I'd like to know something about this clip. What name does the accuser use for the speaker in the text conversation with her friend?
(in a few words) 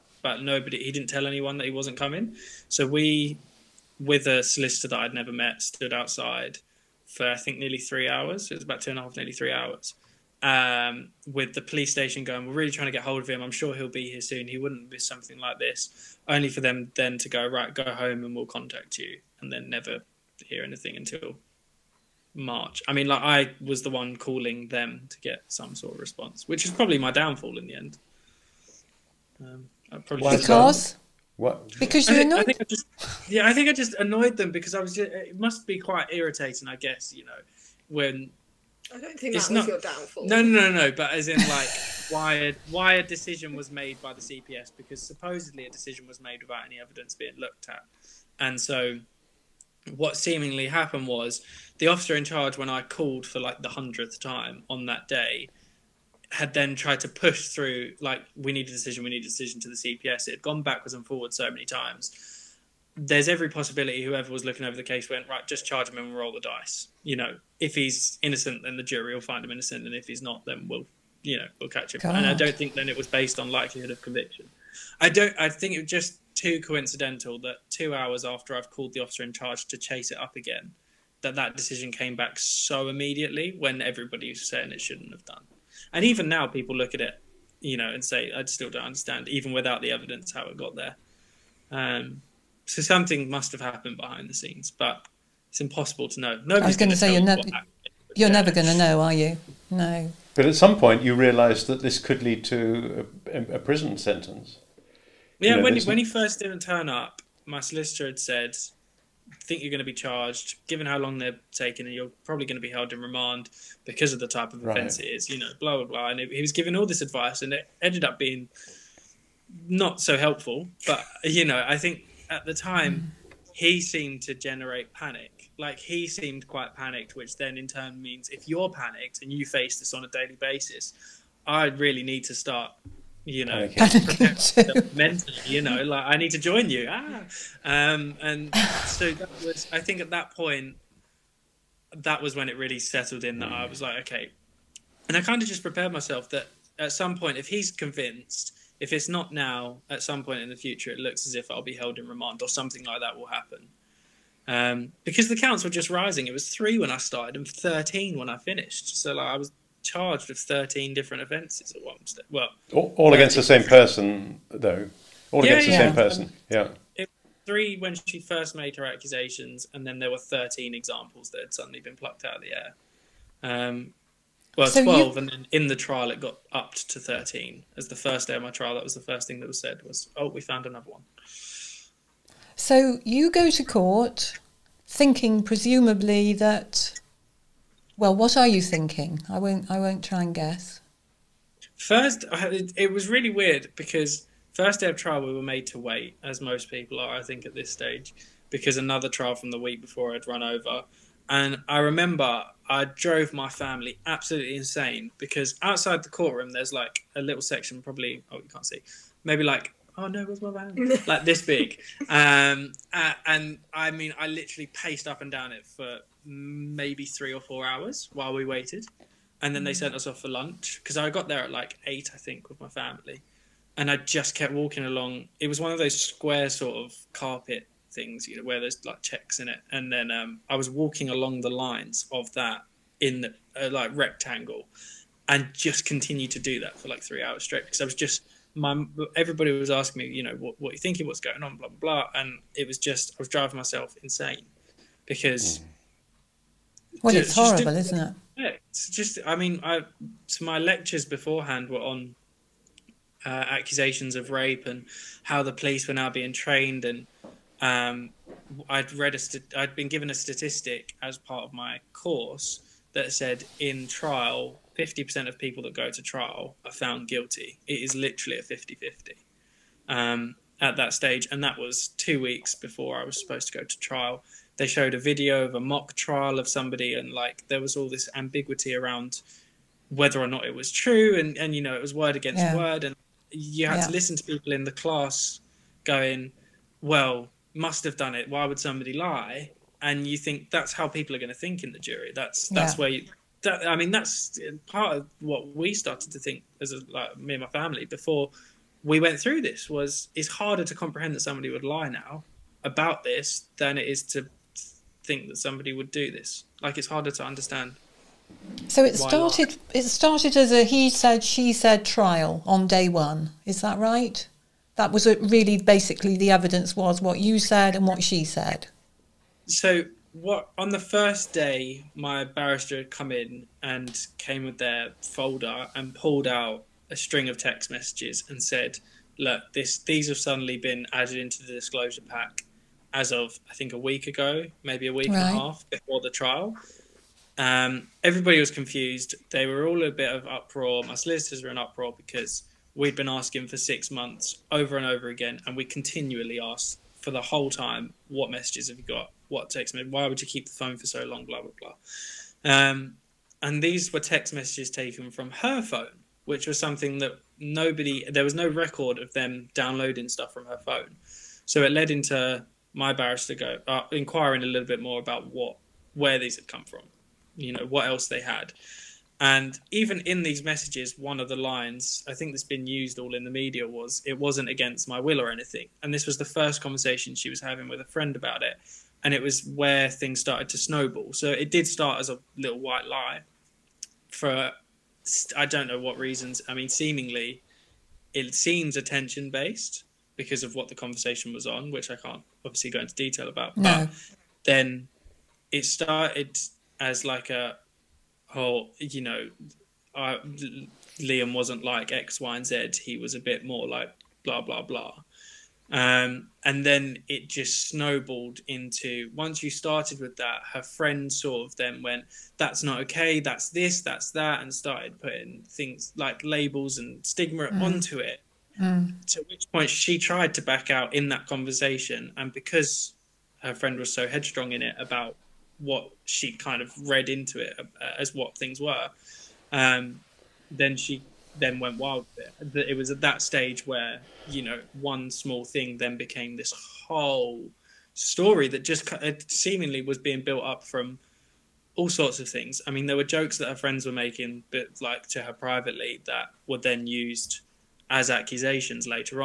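Liam.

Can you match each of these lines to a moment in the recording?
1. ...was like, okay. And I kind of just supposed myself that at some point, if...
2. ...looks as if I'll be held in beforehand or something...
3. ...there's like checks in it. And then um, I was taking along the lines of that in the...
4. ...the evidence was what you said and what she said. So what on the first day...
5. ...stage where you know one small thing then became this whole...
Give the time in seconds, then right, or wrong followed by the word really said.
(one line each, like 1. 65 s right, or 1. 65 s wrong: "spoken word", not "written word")
1. 143 s wrong: "prepared", not "supposed"
2. 150 s wrong: "remand", not "beforehand"
3. 228 s wrong: "walking", not "taking"
4. 316 s right
5. 433 s right.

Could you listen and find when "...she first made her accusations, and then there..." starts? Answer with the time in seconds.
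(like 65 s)
168 s.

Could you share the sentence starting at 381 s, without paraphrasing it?
So it did start as a little white lie, for I don't know what reasons.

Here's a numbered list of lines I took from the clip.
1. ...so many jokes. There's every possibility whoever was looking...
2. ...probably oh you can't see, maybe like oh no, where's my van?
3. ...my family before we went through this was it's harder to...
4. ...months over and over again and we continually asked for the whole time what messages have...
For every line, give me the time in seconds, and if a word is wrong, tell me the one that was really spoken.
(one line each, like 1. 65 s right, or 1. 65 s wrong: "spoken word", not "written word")
1. 61 s wrong: "times", not "jokes"
2. 207 s right
3. 297 s right
4. 343 s right.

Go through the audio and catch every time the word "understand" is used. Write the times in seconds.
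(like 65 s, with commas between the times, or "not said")
88 s, 307 s.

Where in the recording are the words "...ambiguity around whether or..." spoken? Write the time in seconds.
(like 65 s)
278 s.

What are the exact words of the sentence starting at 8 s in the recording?
It was about two and a half, nearly three hours.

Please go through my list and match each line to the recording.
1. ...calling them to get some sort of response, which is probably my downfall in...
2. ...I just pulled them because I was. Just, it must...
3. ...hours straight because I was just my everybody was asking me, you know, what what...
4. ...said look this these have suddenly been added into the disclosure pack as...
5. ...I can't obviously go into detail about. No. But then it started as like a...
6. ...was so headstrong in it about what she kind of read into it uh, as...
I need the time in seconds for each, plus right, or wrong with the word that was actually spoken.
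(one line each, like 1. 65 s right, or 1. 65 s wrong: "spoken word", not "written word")
1. 24 s right
2. 33 s wrong: "annoyed", not "pulled"
3. 237 s right
4. 328 s right
5. 391 s right
6. 423 s right.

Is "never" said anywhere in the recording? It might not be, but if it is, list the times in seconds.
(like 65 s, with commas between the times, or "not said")
5 s, 19 s, 98 s.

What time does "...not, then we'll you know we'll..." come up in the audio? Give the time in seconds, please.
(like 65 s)
70 s.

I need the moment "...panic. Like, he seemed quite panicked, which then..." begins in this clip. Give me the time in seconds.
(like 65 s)
124 s.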